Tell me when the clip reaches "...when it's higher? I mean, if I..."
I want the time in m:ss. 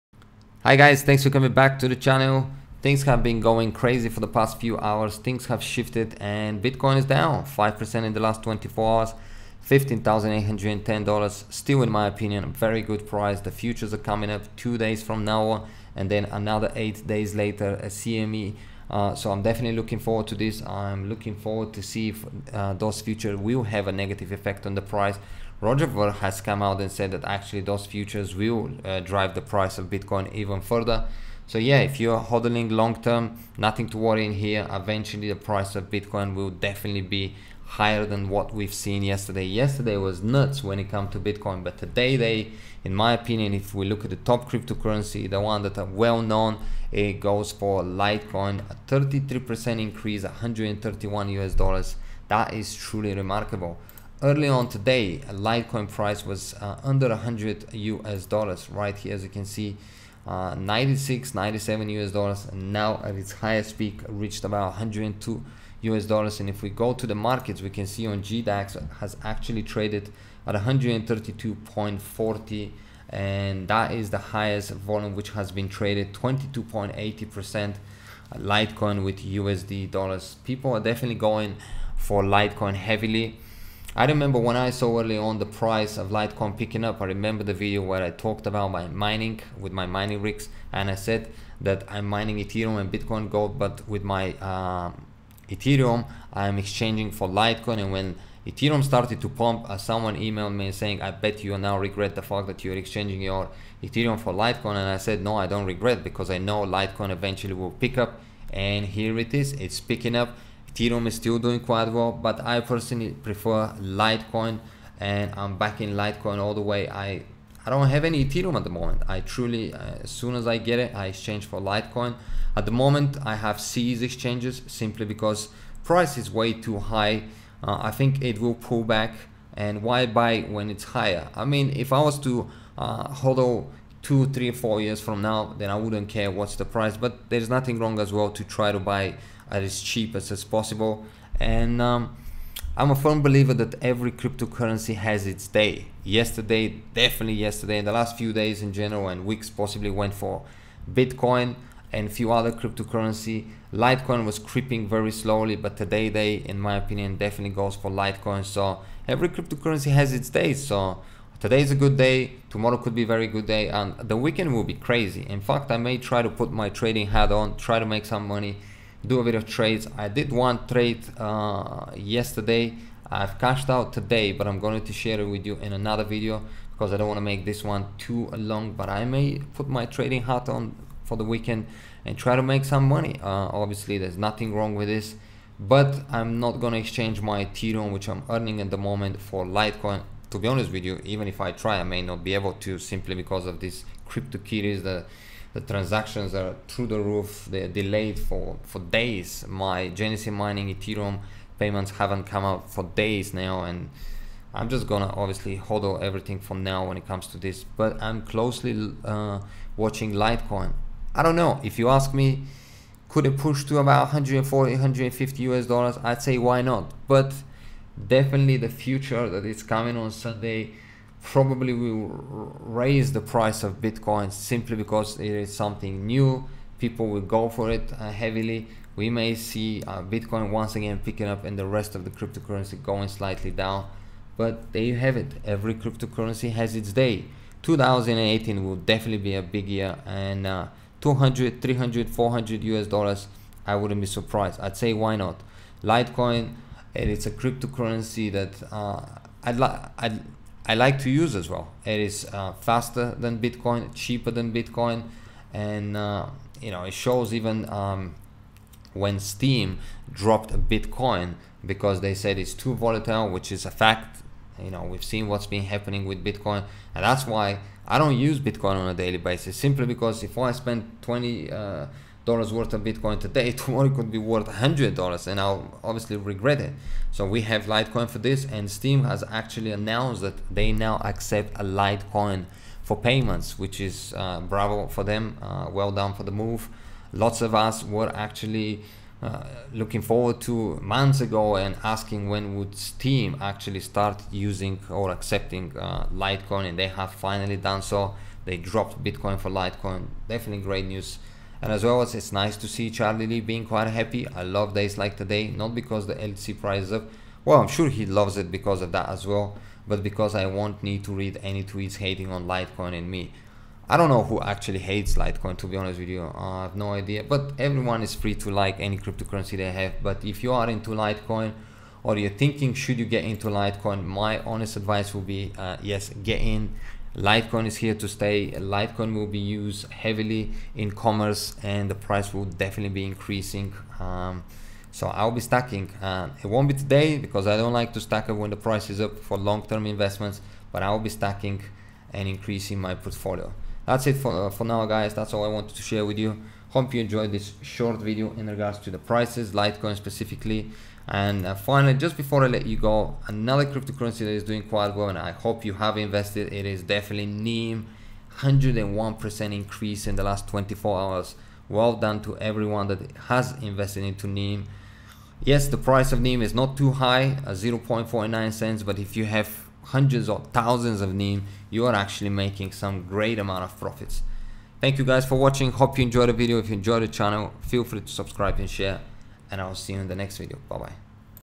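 2:10.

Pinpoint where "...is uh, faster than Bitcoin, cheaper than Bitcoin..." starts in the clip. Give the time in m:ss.
4:11.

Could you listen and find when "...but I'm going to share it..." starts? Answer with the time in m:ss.
2:54.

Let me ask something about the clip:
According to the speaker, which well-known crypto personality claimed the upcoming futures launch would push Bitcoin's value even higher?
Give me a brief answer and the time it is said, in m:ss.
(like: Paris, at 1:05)
Roger Ver, at 0:25.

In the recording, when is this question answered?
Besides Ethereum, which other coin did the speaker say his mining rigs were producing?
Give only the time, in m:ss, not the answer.
1:32.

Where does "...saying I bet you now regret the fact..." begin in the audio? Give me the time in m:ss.
1:40.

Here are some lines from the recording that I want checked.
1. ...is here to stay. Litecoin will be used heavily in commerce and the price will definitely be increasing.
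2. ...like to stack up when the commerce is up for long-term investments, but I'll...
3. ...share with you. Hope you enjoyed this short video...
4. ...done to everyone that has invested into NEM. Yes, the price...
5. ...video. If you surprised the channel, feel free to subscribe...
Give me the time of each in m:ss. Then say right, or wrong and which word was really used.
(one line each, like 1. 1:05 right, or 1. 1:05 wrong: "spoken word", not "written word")
1. 5:27 right
2. 5:37 wrong: "price", not "commerce"
3. 5:45 right
4. 6:01 right
5. 6:16 wrong: "enjoyed", not "surprised".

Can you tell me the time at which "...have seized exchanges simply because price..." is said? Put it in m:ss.
2:03.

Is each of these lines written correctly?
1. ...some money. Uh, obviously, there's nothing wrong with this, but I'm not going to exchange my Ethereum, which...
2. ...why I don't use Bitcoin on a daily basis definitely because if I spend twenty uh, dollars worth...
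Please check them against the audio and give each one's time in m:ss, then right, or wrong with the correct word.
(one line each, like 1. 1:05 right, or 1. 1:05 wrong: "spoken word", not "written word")
1. 3:02 right
2. 4:27 wrong: "simply", not "definitely".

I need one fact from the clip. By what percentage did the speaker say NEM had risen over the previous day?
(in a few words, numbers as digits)
101%.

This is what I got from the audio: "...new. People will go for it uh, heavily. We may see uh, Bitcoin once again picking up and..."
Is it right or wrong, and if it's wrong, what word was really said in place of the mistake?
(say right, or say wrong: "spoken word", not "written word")
right.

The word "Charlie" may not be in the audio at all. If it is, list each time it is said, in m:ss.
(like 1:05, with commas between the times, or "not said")
5:02.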